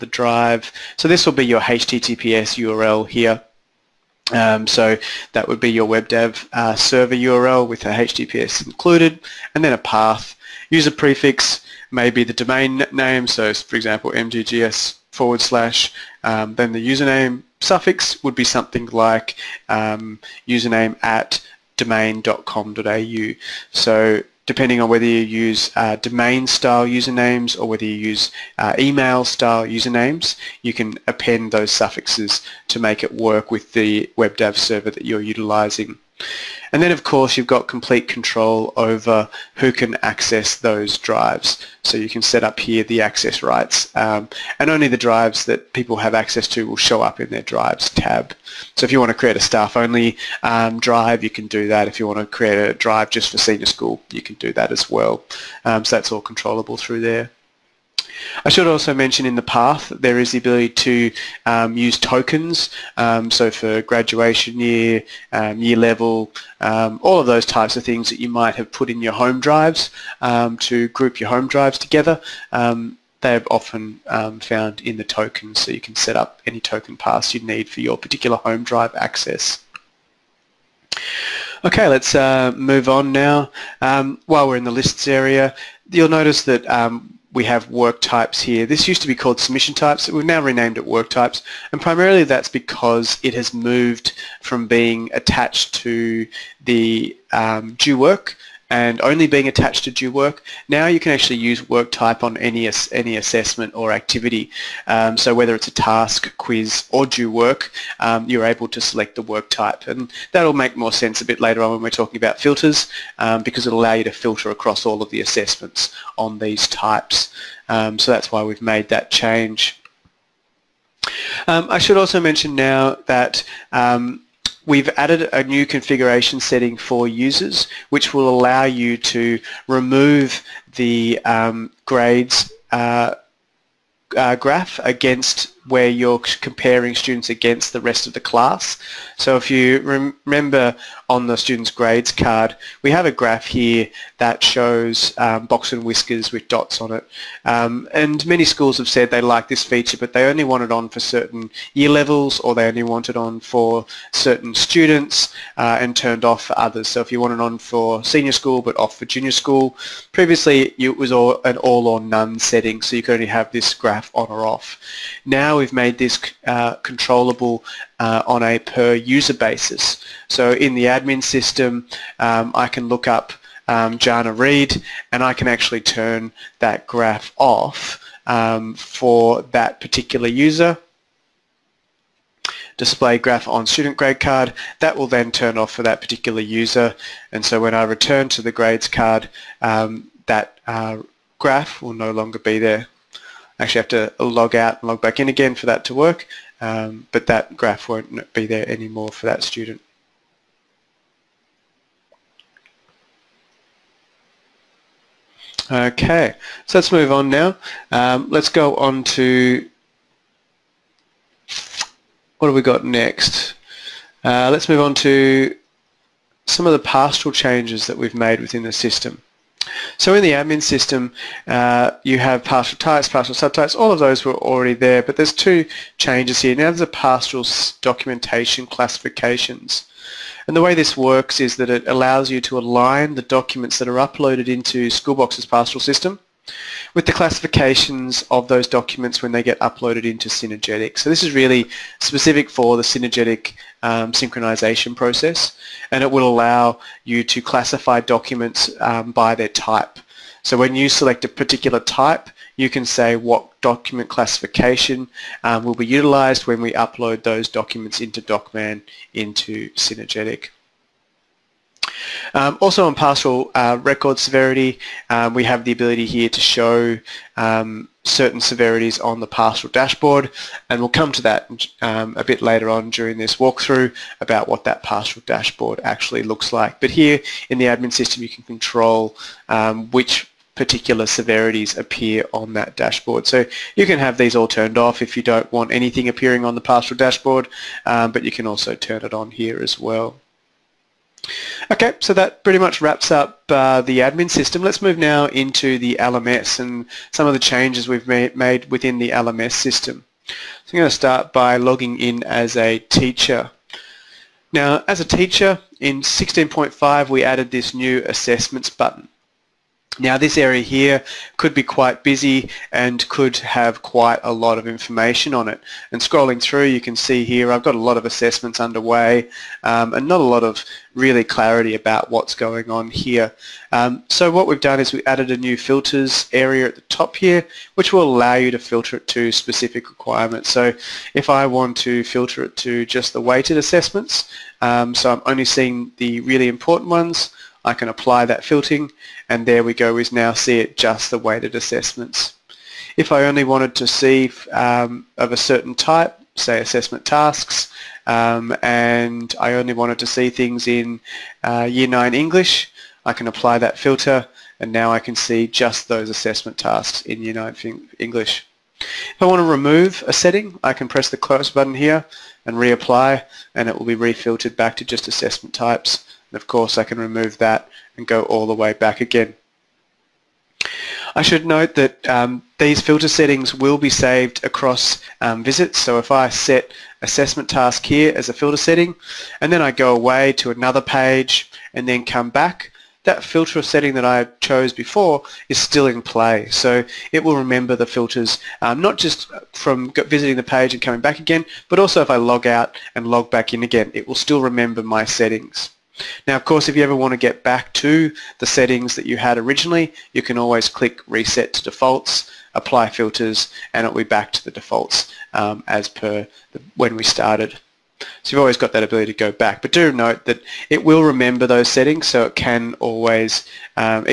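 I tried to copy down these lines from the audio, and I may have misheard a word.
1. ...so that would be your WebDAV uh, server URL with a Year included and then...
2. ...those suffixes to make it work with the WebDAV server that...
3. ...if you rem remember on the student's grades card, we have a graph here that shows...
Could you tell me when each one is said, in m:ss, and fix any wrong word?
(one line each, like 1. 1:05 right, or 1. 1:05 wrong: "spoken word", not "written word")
1. 0:04 wrong: "HTTPS", not "Year"
2. 0:31 right
3. 2:19 right.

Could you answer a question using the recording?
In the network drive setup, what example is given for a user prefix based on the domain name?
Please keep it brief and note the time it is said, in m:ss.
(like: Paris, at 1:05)
mggs/, at 0:14.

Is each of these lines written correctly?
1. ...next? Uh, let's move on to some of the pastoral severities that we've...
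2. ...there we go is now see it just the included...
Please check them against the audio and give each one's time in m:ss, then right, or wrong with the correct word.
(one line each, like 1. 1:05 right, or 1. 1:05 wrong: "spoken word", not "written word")
1. 3:32 wrong: "changes", not "severities"
2. 5:39 wrong: "weighted", not "included".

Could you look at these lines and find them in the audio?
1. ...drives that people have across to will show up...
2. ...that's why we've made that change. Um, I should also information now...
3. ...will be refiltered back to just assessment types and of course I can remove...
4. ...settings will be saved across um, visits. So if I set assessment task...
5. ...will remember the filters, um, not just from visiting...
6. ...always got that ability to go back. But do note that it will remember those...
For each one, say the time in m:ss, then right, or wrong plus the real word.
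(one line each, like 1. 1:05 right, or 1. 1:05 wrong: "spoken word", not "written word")
1. 0:44 wrong: "access", not "across"
2. 1:58 wrong: "mention", not "information"
3. 6:03 right
4. 6:13 right
5. 6:27 right
6. 6:48 right.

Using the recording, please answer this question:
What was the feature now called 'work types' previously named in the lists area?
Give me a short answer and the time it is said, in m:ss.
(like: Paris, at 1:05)
Submission types, at 1:29.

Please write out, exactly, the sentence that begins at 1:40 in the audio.
Now you can actually use work type on any, any assessment or activity.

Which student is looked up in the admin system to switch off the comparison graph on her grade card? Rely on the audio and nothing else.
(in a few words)
Jana Reed.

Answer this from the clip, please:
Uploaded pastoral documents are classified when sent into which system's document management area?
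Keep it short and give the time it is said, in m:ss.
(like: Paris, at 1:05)
DocMan, at 4:18.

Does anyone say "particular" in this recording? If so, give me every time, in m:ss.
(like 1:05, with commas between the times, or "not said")
1:17, 2:59, 3:05, 4:11, 4:40.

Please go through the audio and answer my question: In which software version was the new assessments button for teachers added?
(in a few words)
16.5.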